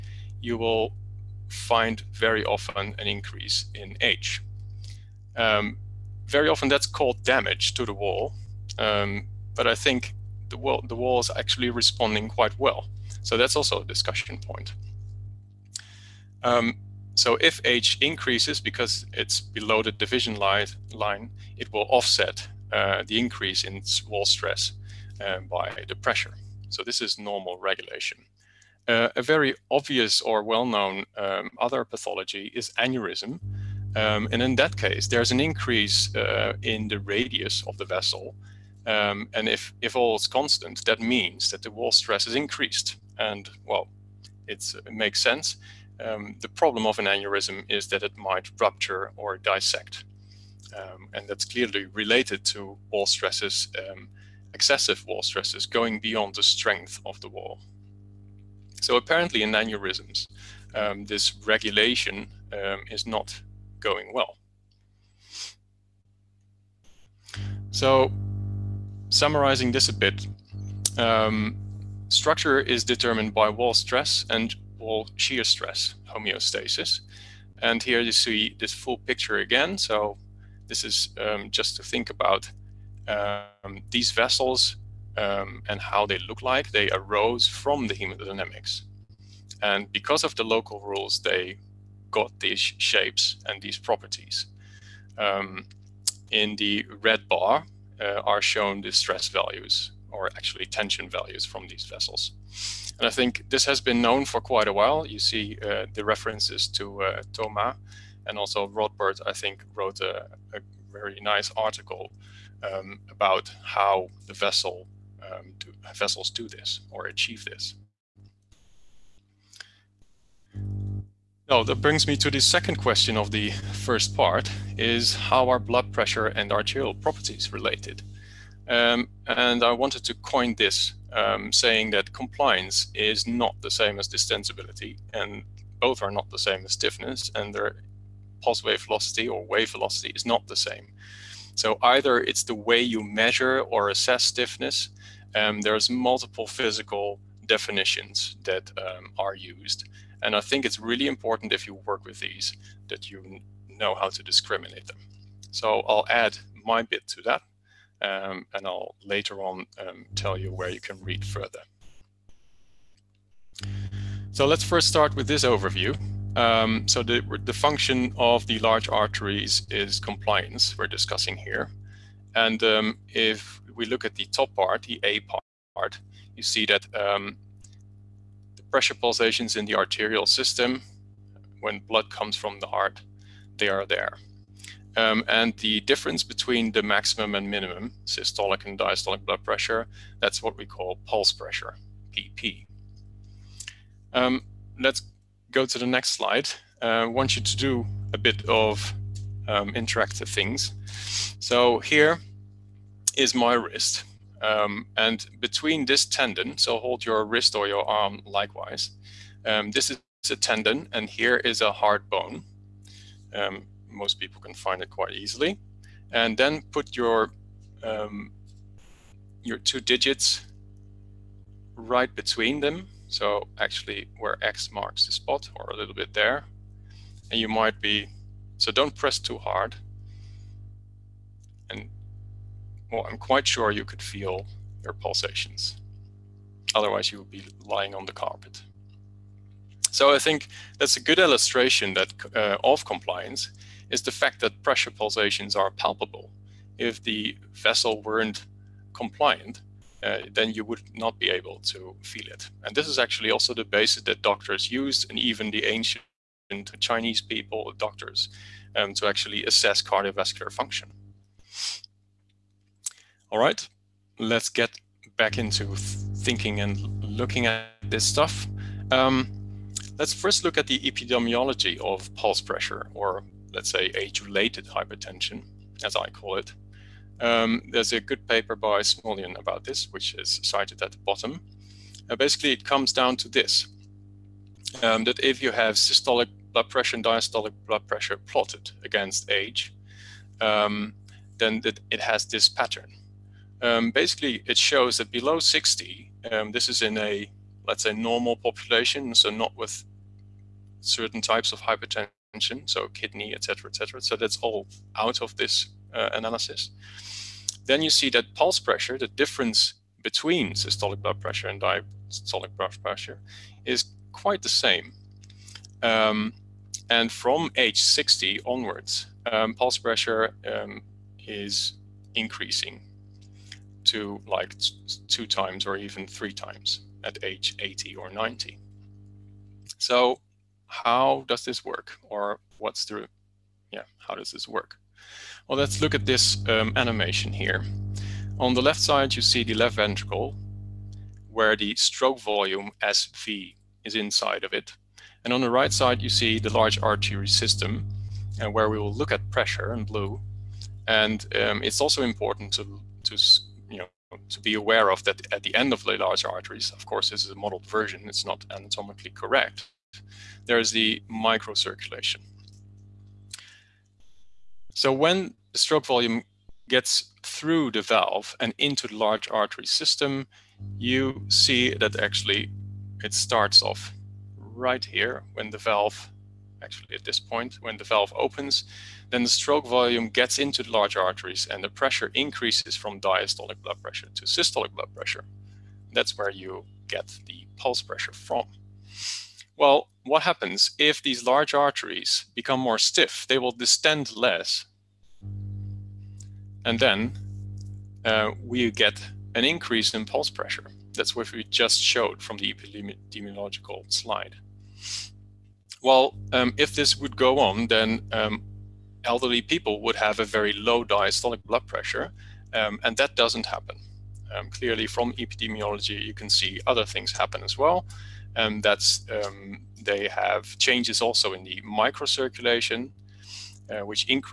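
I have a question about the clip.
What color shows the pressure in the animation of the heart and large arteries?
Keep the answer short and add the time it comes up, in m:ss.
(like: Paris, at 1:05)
Blue, at 5:49.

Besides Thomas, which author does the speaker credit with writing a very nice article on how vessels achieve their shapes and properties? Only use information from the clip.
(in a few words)
Rodbard.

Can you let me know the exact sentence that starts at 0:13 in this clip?
So that's also a discussion point.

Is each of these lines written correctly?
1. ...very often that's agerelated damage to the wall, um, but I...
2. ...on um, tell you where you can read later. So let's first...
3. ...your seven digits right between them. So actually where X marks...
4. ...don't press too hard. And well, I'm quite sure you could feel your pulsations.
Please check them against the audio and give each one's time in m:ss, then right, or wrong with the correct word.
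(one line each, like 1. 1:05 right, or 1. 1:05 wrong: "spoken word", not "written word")
1. 0:06 wrong: "called", not "agerelated"
2. 2:39 wrong: "further", not "later"
3. 3:39 wrong: "two", not "seven"
4. 3:48 right.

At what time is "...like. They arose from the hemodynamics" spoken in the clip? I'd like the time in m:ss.
1:26.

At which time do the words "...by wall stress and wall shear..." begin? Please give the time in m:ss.
1:13.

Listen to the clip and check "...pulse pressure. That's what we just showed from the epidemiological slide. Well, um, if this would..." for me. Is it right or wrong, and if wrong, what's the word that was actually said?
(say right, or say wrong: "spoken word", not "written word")
right.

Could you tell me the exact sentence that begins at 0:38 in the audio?
Um, and if, if all is constant, that means that the wall stress is increased.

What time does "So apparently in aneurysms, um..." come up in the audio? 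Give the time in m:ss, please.
0:58.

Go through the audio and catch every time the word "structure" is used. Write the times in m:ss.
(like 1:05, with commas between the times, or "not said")
1:12.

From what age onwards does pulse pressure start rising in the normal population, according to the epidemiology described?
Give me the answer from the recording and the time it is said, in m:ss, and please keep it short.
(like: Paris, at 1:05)
60, at 5:17.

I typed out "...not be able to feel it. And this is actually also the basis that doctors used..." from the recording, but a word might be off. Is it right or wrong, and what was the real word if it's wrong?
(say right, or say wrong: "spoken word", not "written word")
right.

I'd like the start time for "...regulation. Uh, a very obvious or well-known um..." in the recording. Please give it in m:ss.
0:27.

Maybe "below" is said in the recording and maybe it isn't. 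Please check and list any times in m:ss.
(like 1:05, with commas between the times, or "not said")
0:19, 4:55.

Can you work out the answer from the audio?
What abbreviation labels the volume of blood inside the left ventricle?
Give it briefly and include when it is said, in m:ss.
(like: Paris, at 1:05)
SV, at 5:42.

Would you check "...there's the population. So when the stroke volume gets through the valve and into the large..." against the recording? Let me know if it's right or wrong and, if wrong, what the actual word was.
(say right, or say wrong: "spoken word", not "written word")
wrong: "microcirculation", not "population".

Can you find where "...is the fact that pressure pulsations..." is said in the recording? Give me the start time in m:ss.
4:03.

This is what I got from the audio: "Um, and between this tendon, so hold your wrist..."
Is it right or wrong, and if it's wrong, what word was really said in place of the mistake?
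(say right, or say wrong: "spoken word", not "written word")
right.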